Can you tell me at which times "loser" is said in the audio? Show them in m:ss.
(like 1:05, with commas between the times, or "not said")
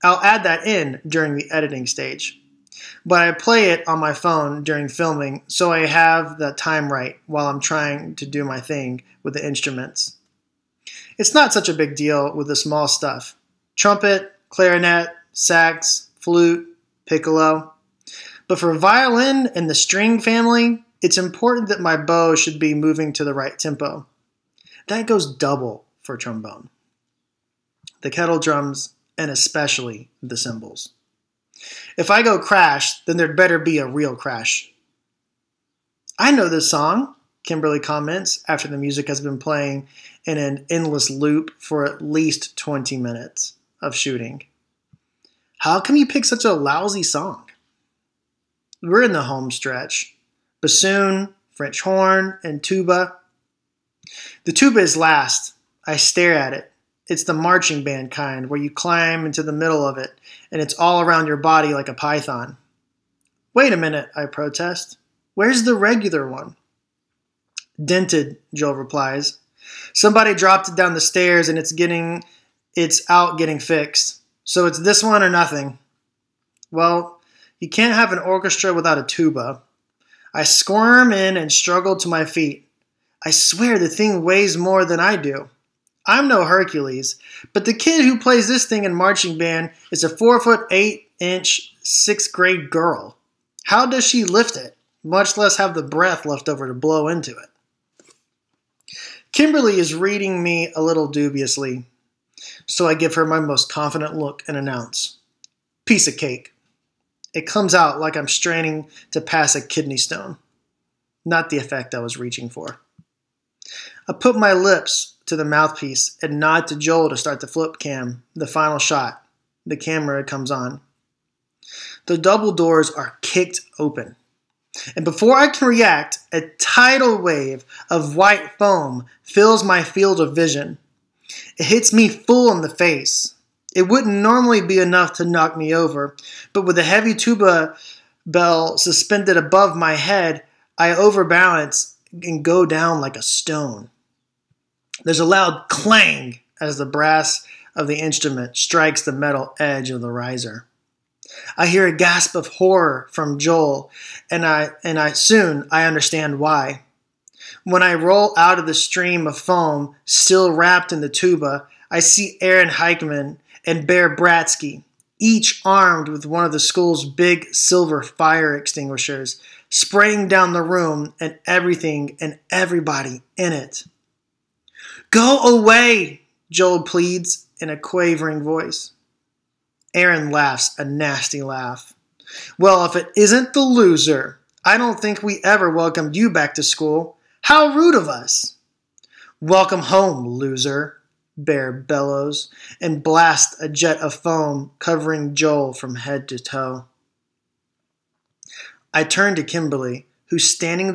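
3:03, 3:10.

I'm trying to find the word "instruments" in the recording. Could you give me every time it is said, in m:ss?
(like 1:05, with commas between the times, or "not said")
0:09, 2:27.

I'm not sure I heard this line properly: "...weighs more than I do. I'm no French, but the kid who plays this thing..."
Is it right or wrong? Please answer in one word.
wrong.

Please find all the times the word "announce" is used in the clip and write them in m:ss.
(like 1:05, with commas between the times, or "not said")
1:44.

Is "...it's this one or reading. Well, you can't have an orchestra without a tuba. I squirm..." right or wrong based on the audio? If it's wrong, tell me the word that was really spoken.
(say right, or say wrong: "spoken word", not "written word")
wrong: "nothing", not "reading".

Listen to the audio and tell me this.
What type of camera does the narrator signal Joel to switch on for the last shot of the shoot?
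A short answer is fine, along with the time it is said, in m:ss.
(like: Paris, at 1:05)
flip cam, at 1:57.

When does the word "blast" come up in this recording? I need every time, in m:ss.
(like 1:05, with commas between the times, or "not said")
3:13.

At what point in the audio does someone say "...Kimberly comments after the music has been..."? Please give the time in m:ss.
0:37.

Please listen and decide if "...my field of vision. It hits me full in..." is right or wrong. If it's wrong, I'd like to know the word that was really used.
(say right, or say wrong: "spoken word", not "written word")
right.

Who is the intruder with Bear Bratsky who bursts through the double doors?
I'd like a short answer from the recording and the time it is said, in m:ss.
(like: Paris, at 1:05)
Aaron Heikman, at 2:42.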